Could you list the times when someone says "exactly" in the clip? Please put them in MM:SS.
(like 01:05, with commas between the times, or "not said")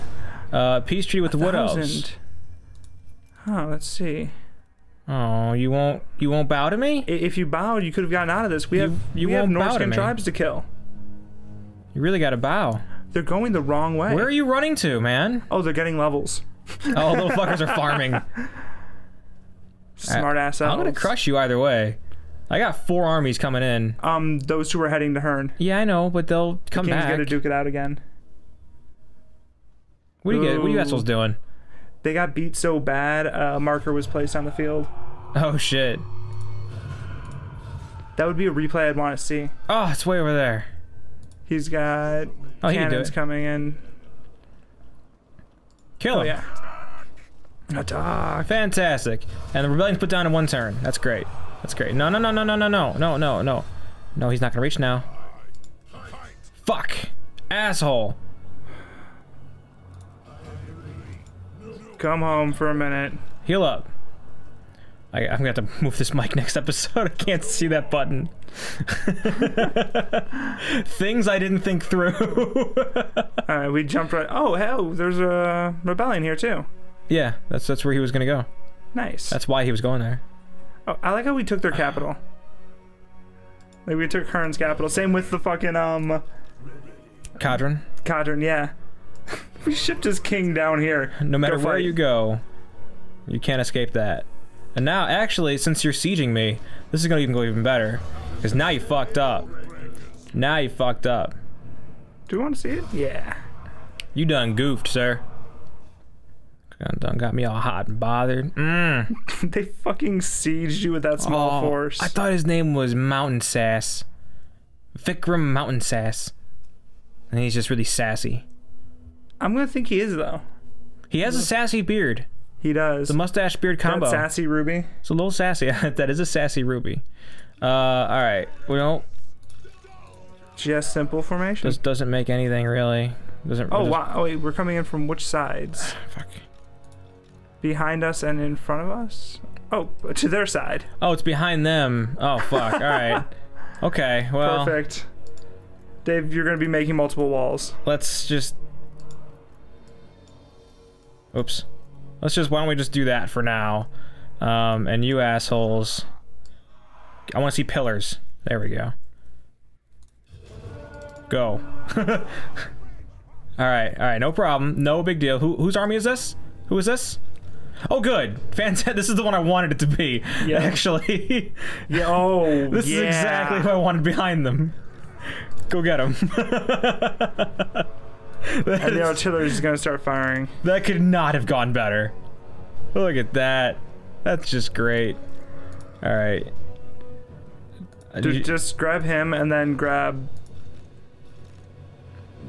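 02:53.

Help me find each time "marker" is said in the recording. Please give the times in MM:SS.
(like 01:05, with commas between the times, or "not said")
00:33.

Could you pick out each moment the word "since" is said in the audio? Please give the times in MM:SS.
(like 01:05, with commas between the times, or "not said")
01:35.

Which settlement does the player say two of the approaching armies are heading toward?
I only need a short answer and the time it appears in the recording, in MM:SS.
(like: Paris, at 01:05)
Hirn, at 00:25.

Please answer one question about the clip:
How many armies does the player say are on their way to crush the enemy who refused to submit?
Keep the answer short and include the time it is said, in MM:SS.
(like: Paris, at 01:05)
4, at 00:22.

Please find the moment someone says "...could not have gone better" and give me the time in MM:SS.
03:00.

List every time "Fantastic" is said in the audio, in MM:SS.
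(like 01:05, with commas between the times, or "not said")
00:48, 02:48.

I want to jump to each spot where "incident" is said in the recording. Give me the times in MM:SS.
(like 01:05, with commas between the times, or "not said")
not said.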